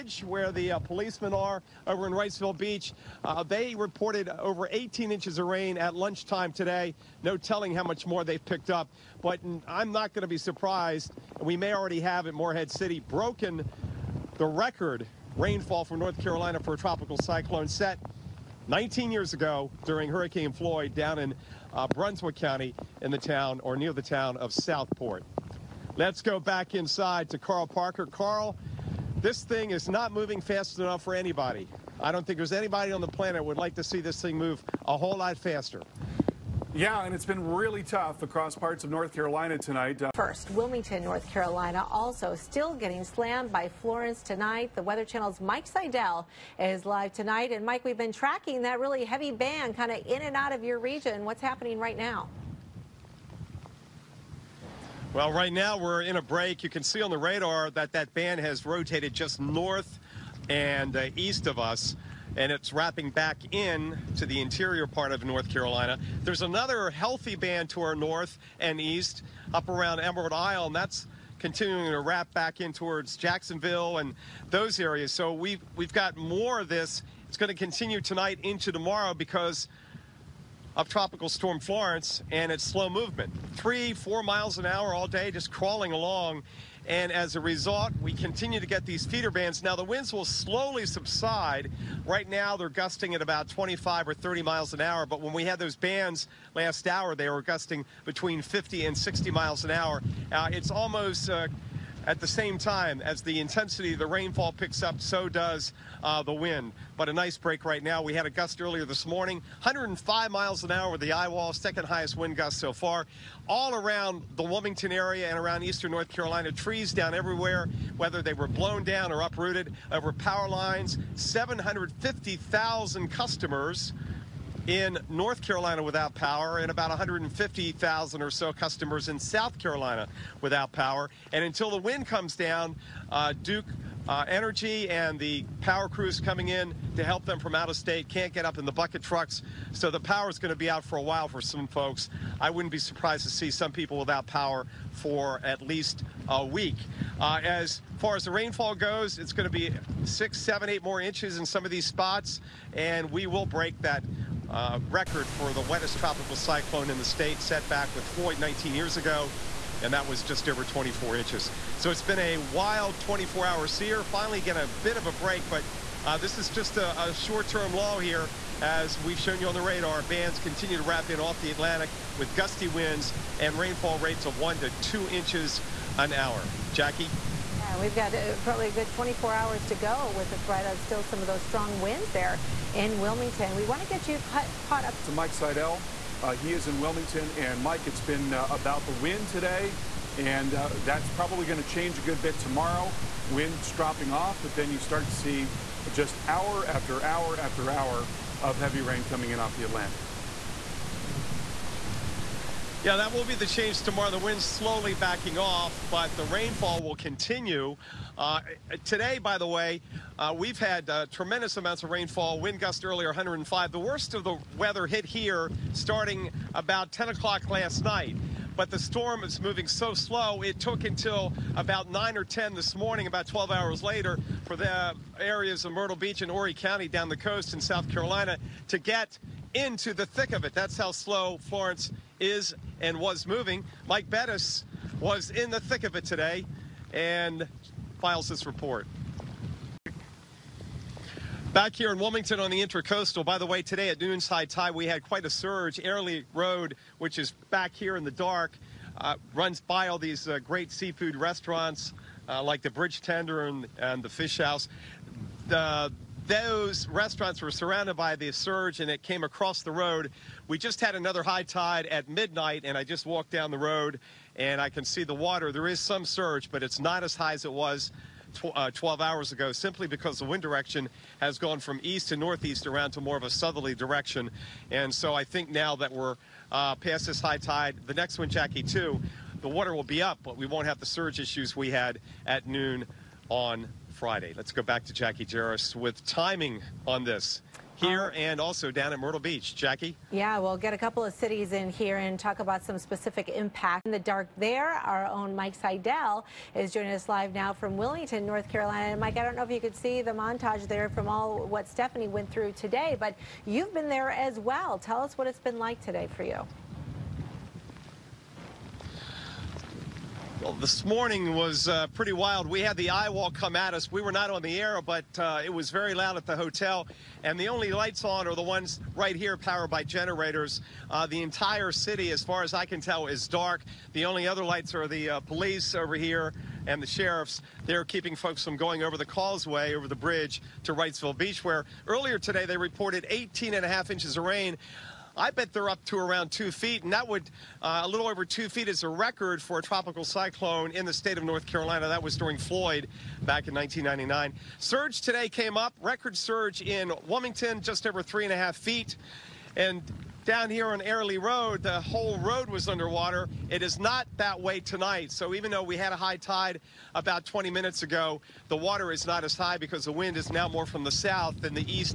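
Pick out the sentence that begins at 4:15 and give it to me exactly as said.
The, those restaurants were surrounded by the surge and it came across the road.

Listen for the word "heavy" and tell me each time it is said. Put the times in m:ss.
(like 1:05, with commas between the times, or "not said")
0:49, 3:18.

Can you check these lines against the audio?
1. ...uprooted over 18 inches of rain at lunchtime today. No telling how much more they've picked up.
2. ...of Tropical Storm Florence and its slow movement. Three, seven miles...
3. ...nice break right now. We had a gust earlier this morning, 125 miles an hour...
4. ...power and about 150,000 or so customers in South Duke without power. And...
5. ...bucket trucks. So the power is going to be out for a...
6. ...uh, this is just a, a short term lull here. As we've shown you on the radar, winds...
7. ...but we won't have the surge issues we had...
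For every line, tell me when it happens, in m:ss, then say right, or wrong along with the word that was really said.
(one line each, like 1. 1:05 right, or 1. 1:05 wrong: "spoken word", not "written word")
1. 0:03 wrong: "reported", not "uprooted"
2. 1:20 wrong: "four", not "seven"
3. 1:47 wrong: "105", not "125"
4. 2:06 wrong: "Carolina", not "Duke"
5. 2:18 right
6. 2:46 wrong: "bands", not "winds"
7. 4:40 right.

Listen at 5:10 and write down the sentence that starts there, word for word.
Well, this morning was uh, pretty wild.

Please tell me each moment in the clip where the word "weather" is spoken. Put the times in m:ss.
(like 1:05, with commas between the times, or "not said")
0:44, 3:34.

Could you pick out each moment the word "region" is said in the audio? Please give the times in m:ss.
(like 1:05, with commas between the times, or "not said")
0:50.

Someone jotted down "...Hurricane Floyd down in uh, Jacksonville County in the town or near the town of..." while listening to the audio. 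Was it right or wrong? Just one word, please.
wrong.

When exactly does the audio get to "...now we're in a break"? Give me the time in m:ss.
0:55.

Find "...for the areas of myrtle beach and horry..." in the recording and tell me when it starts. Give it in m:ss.
3:44.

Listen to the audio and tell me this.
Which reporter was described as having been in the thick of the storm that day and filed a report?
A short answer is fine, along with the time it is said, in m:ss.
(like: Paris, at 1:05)
Mike Bettis, at 3:53.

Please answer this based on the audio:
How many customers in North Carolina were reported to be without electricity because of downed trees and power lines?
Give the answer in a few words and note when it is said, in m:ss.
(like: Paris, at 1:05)
750,000, at 2:01.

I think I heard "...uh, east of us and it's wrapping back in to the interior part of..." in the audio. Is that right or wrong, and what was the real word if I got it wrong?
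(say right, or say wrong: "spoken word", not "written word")
right.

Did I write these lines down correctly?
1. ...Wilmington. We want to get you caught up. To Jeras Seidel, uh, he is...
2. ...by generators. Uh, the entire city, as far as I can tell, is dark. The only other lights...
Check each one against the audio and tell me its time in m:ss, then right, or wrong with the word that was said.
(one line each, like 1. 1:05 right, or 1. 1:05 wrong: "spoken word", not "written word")
1. 3:02 wrong: "Mike", not "Jeras"
2. 5:19 right.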